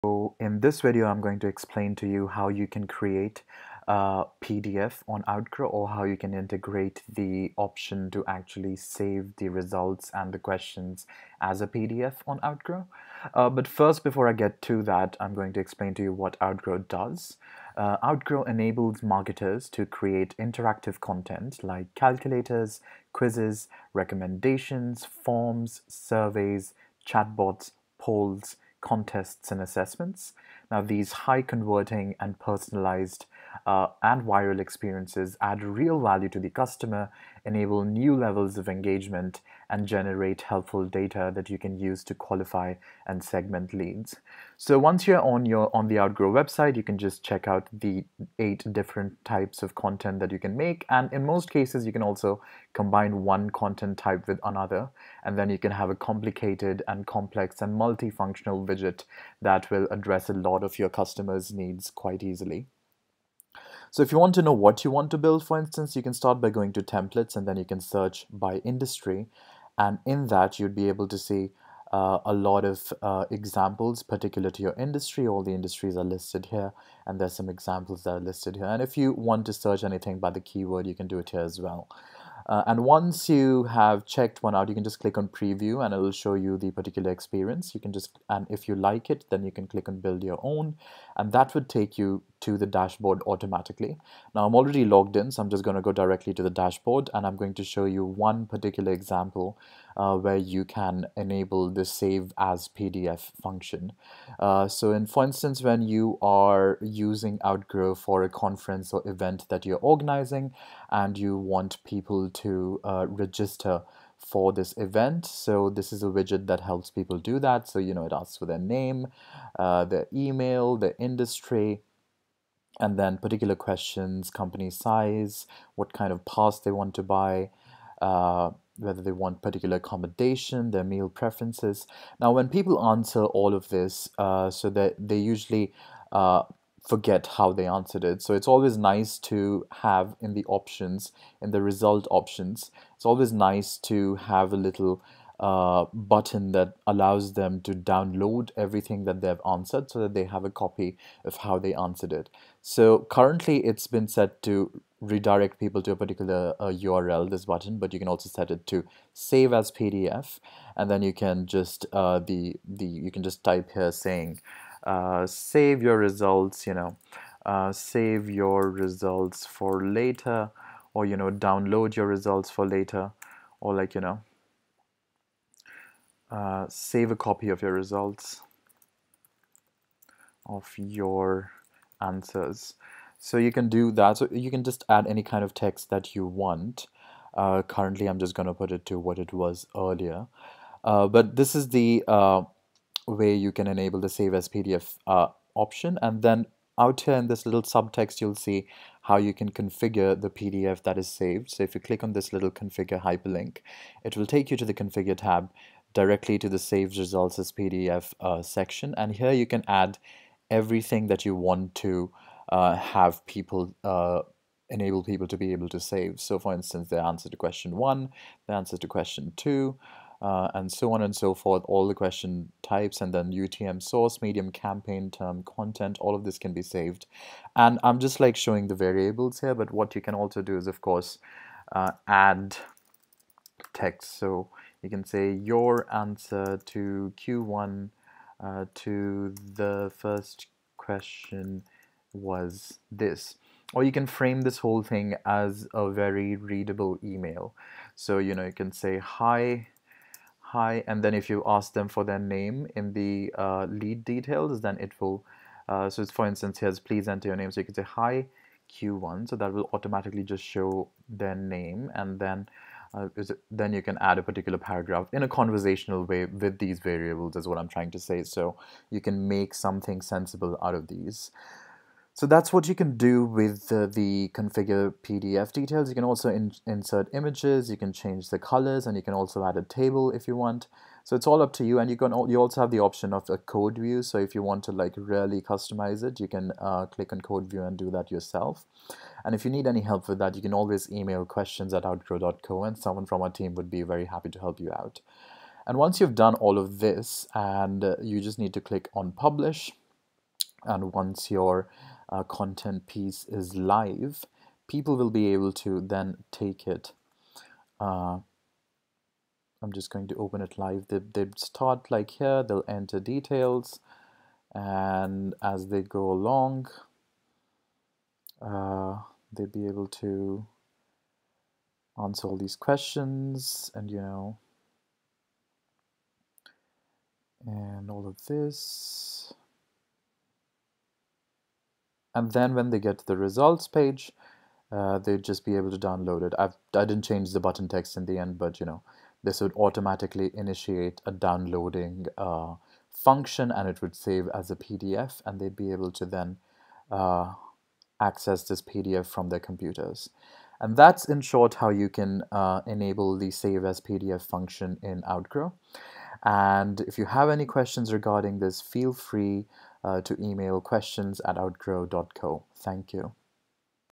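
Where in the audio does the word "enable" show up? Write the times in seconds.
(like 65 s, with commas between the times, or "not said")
18 s, 37 s, 101 s, 193 s, 214 s, 352 s.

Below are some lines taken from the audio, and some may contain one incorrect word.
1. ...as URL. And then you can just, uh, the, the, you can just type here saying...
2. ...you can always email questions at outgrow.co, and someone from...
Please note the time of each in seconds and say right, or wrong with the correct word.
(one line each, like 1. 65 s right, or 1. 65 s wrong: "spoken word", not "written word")
1. 159 s wrong: "PDF", not "URL"
2. 290 s right.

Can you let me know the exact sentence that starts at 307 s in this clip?
Uh, I'm just going to open it live.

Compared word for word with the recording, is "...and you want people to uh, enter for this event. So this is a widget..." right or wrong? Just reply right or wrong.
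wrong.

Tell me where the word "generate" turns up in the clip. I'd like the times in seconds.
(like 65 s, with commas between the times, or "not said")
39 s.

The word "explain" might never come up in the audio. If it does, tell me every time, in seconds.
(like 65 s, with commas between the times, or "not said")
1 s, 15 s.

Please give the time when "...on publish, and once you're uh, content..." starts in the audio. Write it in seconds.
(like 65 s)
298 s.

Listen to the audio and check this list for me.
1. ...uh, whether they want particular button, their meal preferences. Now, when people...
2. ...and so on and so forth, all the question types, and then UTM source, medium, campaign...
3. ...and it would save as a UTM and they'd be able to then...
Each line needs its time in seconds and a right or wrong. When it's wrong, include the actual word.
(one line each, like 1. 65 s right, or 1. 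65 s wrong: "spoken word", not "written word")
1. 128 s wrong: "accommodation", not "button"
2. 220 s right
3. 343 s wrong: "PDF", not "UTM".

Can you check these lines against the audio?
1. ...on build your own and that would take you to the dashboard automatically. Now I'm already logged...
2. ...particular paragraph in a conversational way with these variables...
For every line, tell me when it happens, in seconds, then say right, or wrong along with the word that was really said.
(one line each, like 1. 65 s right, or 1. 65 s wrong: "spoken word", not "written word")
1. 89 s right
2. 264 s right.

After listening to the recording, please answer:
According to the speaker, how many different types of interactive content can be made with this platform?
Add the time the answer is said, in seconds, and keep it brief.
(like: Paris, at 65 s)
8, at 48 s.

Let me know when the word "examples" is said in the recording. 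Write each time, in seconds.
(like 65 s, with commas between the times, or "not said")
73 s, 77 s, 98 s.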